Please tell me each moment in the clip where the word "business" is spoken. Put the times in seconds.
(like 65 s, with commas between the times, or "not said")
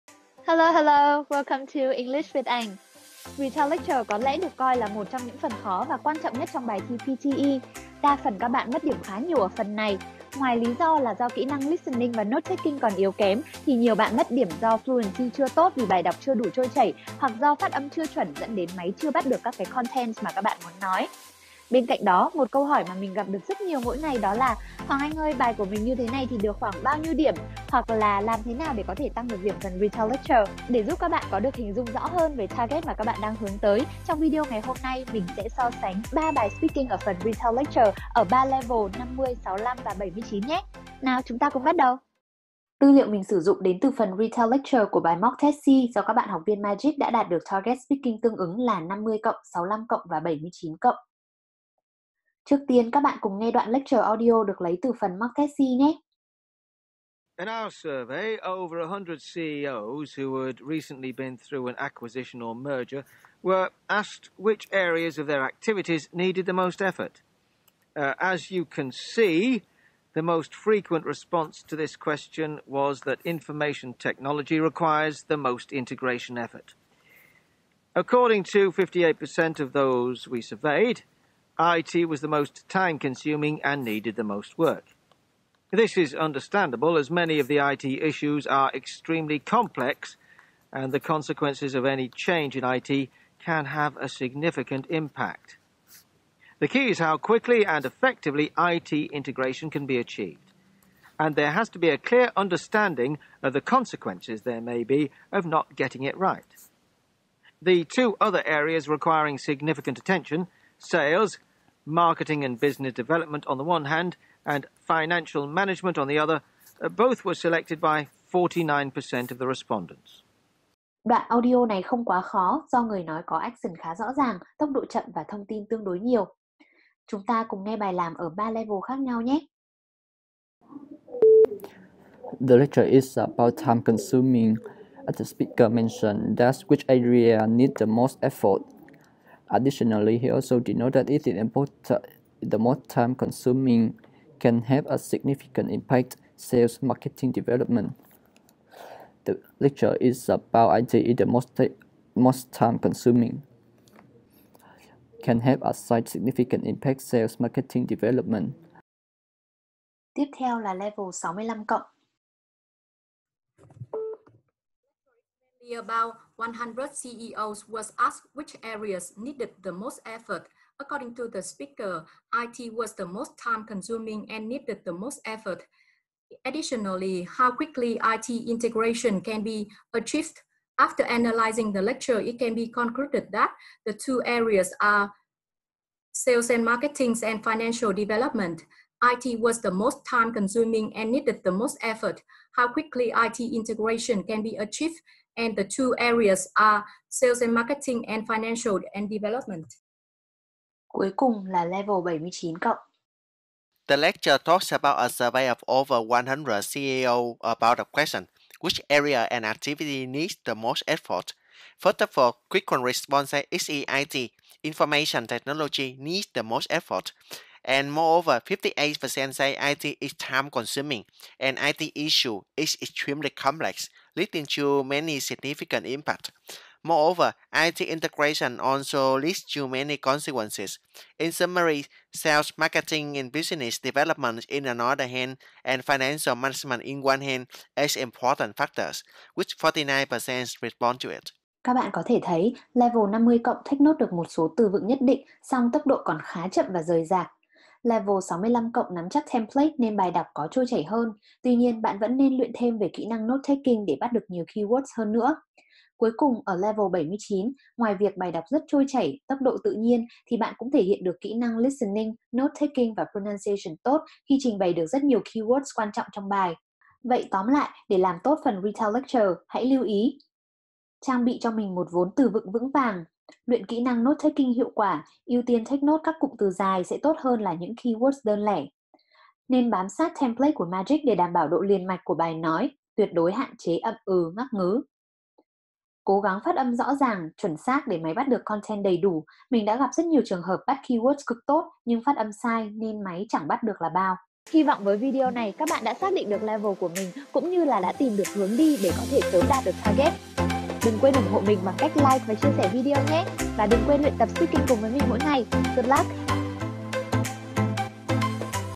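112 s, 233 s.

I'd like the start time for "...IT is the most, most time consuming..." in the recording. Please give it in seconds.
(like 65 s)
150 s.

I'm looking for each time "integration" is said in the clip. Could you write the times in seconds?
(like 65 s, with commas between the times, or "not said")
75 s, 98 s, 178 s, 193 s, 227 s.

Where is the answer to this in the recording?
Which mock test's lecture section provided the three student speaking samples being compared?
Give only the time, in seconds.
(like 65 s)
45 s.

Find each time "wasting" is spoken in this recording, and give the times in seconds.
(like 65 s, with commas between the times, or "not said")
not said.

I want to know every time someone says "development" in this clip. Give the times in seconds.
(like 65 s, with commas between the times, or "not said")
112 s, 147 s, 157 s, 187 s, 199 s, 233 s.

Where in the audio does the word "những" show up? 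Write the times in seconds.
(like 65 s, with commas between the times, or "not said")
5 s, 277 s.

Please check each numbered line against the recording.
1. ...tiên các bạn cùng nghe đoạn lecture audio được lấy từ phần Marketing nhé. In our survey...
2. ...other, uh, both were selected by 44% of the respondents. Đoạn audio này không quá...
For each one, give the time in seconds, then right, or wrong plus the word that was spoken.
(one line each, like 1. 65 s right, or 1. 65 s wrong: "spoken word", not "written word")
1. 52 s right
2. 116 s wrong: "49", not "44".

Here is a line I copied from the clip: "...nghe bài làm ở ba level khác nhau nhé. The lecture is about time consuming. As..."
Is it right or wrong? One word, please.
right.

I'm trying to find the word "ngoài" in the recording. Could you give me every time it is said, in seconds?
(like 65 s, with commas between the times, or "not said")
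10 s, 257 s.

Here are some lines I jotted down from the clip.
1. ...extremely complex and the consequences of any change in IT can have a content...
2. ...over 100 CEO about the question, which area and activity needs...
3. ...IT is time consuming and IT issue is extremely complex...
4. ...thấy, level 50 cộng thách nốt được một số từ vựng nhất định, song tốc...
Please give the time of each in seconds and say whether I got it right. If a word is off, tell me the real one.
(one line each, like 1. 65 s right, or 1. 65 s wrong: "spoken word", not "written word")
1. 88 s wrong: "significant", not "content"
2. 205 s right
3. 219 s right
4. 242 s right.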